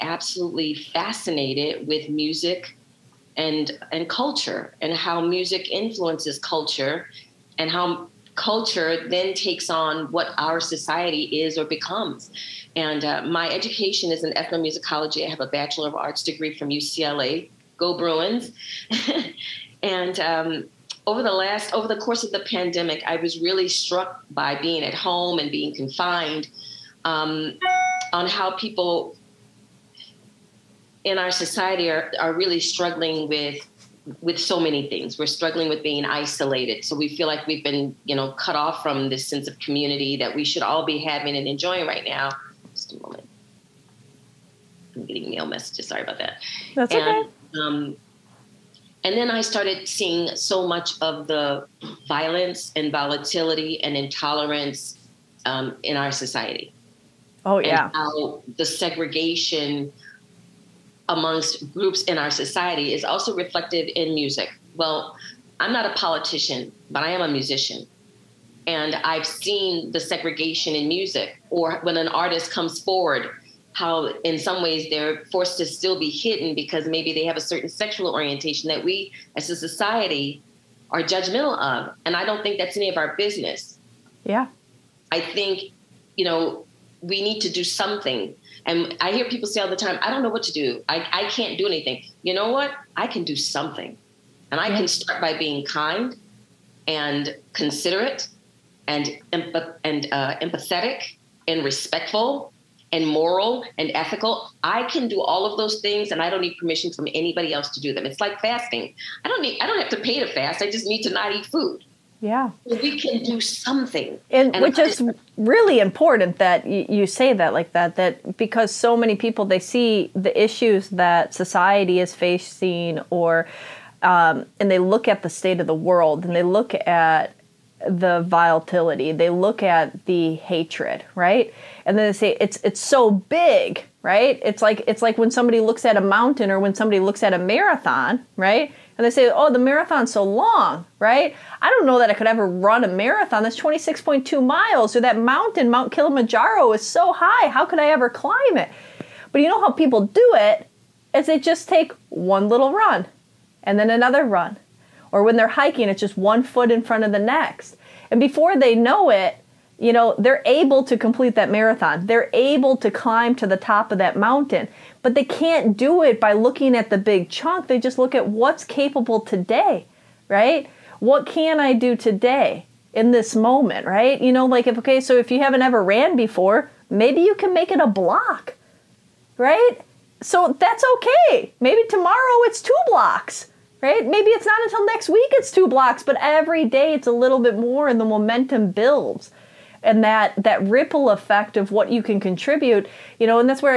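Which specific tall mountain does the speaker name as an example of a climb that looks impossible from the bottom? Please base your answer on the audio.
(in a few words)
Mount Kilimanjaro.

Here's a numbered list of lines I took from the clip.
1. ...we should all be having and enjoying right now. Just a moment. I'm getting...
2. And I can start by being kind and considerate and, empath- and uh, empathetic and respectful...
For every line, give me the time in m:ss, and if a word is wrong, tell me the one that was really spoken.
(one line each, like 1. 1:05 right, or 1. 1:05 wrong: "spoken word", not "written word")
1. 0:40 right
2. 1:34 right.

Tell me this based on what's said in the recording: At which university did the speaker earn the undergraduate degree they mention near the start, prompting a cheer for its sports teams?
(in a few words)
UCLA.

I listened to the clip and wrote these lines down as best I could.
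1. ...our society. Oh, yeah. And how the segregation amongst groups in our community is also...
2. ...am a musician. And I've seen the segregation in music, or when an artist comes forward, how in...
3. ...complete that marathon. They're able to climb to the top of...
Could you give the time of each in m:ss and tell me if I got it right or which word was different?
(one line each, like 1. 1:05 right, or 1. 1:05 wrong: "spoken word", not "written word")
1. 0:55 wrong: "society", not "community"
2. 1:07 right
3. 2:40 right.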